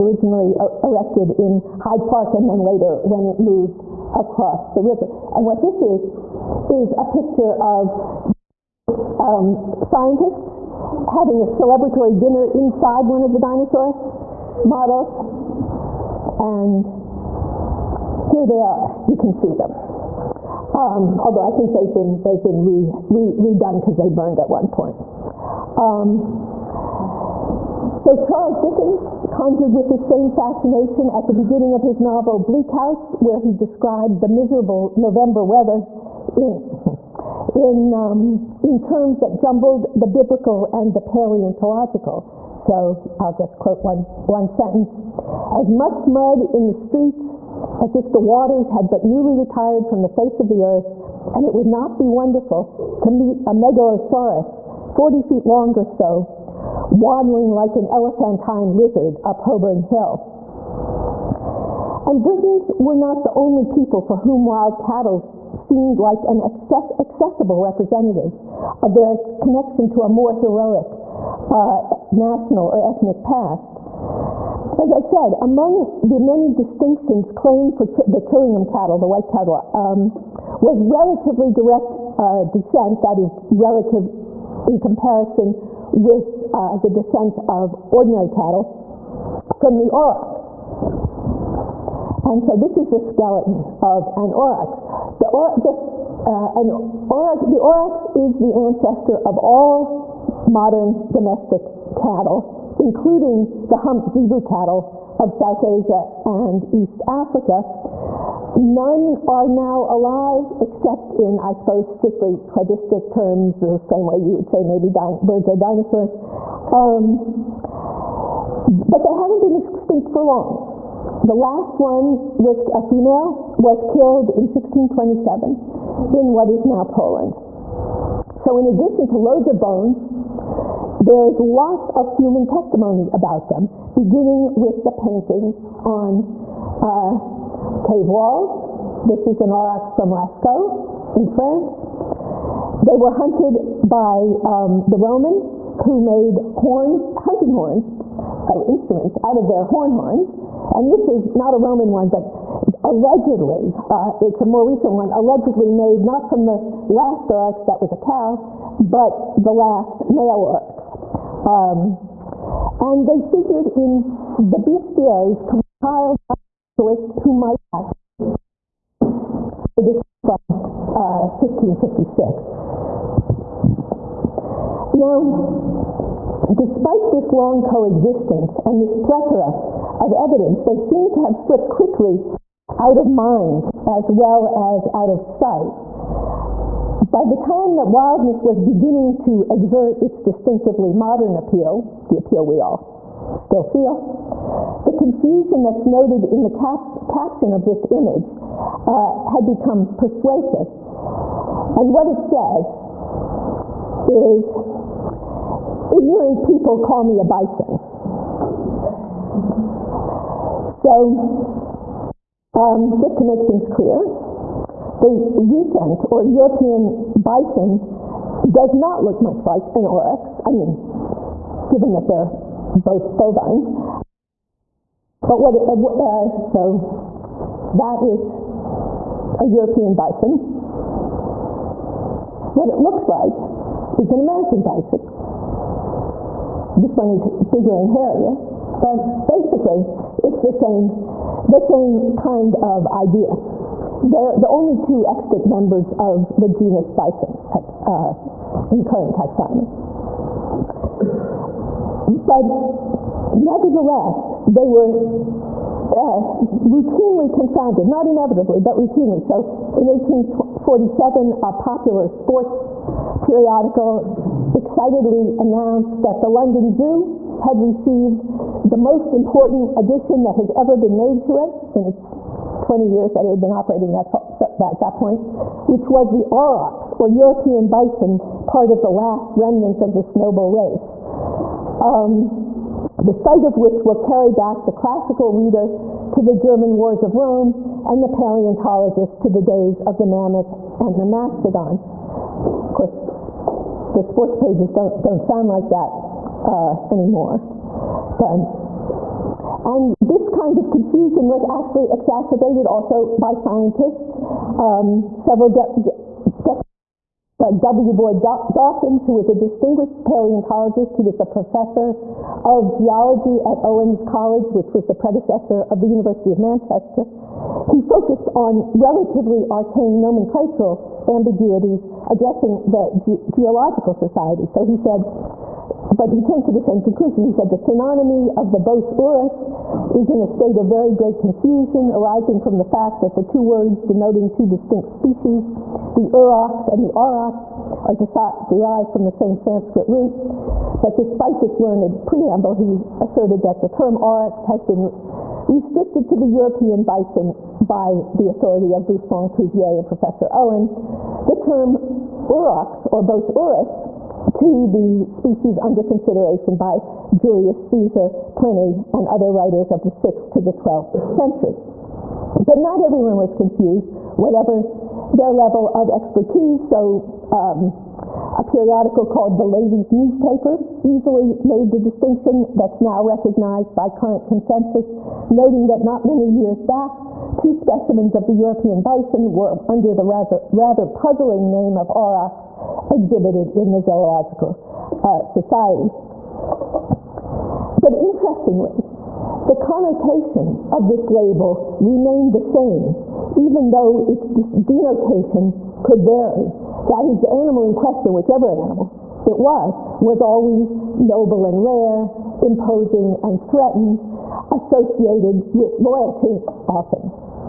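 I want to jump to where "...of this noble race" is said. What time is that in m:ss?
4:39.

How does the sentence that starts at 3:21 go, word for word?
And what it says is ignorant people call me a bison.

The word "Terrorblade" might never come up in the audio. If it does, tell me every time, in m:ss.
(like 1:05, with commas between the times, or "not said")
not said.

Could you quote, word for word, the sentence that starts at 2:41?
Um, and they figured in the bestiaries compiled by a naturalist who might actually.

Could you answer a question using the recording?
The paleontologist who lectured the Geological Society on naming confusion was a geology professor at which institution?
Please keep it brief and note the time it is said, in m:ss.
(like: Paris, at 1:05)
Owens College, at 5:13.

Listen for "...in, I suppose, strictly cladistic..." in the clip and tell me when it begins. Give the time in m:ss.
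1:51.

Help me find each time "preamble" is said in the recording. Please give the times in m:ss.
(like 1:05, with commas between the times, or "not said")
5:42.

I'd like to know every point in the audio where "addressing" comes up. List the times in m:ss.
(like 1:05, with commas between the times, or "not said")
5:22.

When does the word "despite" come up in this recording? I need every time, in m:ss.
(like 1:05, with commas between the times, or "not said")
2:56, 5:40.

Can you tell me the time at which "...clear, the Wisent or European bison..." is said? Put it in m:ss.
3:33.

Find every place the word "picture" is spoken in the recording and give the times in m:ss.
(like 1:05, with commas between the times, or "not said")
0:07.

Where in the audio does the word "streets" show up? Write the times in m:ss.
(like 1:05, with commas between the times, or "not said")
0:46.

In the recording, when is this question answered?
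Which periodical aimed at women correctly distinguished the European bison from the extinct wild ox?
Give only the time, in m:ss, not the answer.
6:09.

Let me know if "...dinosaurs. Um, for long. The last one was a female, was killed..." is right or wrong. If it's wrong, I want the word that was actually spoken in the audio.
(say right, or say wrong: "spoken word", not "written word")
right.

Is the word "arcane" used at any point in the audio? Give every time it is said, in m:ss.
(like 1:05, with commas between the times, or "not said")
5:19.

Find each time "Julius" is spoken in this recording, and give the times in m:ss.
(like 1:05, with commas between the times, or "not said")
5:57.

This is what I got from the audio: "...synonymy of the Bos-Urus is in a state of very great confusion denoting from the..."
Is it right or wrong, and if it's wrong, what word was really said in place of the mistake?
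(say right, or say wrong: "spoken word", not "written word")
wrong: "arising", not "denoting".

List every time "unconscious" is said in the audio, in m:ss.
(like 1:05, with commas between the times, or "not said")
not said.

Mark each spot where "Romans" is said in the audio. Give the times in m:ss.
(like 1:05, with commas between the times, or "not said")
2:24, 2:31.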